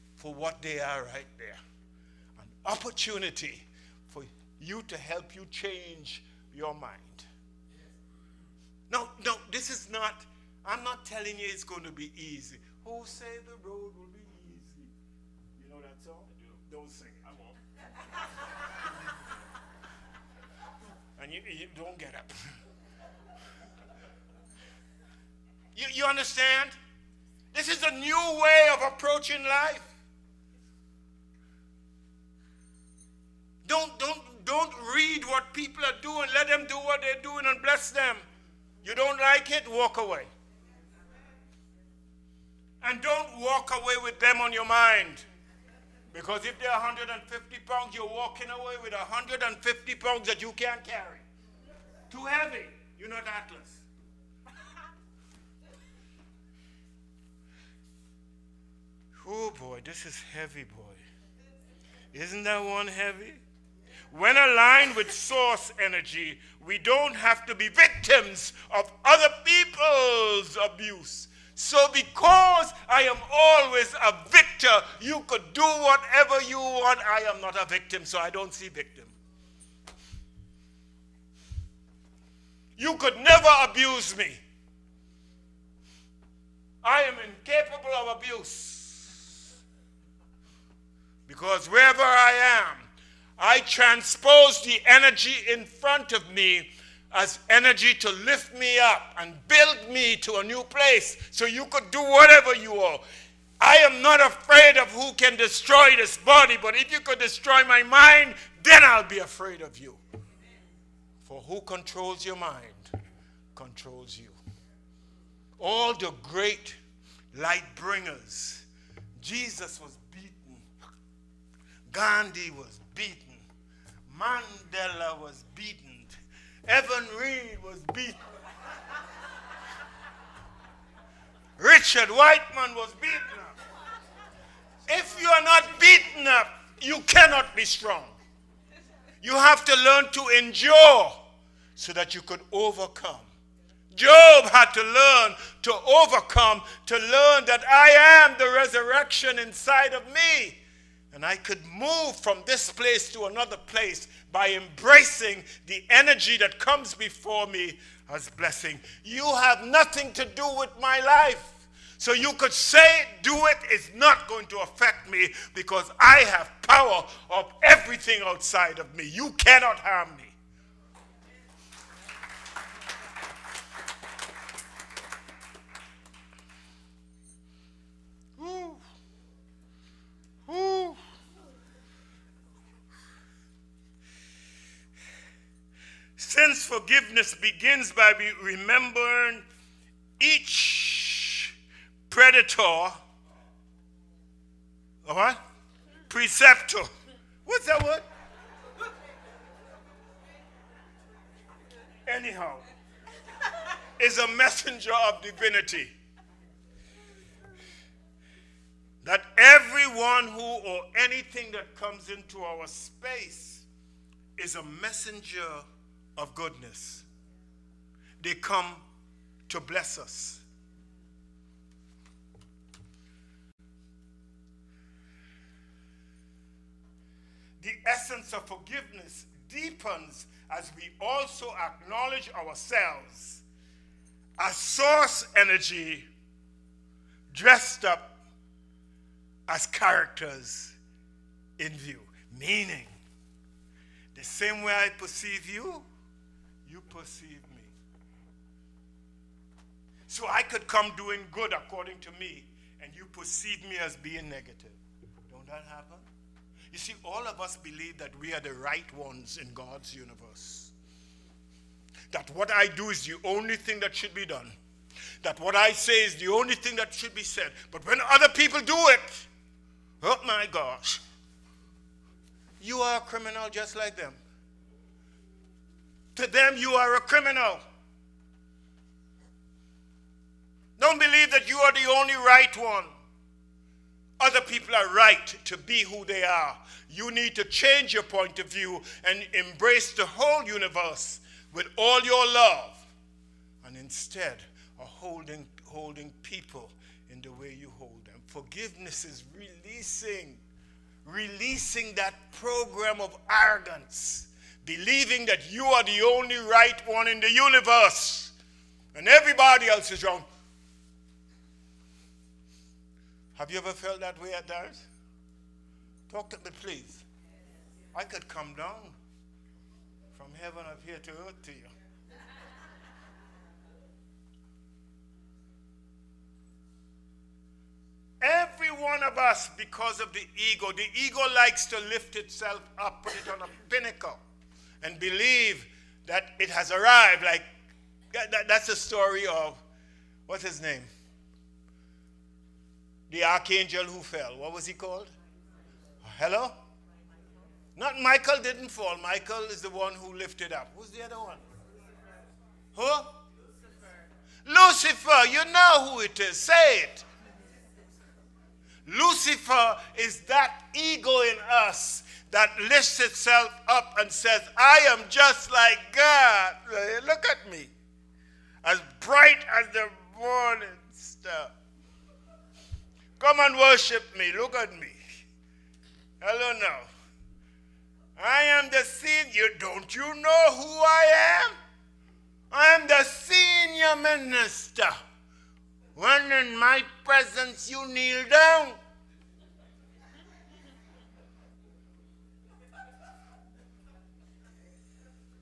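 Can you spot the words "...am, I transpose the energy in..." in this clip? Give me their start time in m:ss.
1:32.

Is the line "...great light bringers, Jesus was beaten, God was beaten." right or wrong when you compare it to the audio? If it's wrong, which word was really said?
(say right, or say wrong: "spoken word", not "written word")
wrong: "Gandhi", not "God".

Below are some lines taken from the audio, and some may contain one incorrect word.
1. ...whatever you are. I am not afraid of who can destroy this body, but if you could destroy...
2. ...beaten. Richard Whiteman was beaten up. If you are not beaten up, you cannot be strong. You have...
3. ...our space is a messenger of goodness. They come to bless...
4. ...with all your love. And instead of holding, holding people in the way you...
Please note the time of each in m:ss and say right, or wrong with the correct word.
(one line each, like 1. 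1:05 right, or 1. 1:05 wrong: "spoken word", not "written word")
1. 1:42 right
2. 2:07 right
3. 3:32 right
4. 4:51 right.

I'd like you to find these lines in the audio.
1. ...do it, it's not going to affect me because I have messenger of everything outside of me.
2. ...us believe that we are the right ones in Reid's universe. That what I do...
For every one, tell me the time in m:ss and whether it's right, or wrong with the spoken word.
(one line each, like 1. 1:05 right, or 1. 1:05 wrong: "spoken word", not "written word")
1. 2:43 wrong: "power", not "messenger"
2. 4:17 wrong: "God", not "Reid".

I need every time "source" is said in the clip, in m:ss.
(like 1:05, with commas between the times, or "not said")
1:05, 3:54.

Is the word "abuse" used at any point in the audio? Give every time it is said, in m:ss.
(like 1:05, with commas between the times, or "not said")
1:10, 1:23, 1:28.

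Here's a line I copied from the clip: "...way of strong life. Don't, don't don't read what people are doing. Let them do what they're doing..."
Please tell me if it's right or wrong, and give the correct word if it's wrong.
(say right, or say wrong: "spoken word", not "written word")
wrong: "approaching", not "strong".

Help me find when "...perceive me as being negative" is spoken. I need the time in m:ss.
4:13.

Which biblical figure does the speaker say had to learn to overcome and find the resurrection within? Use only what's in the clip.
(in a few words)
Job.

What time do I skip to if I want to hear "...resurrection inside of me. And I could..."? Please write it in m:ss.
2:28.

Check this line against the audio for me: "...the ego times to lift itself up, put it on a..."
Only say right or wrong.
wrong.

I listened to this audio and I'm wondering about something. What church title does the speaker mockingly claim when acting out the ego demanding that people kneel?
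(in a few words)
senior minister.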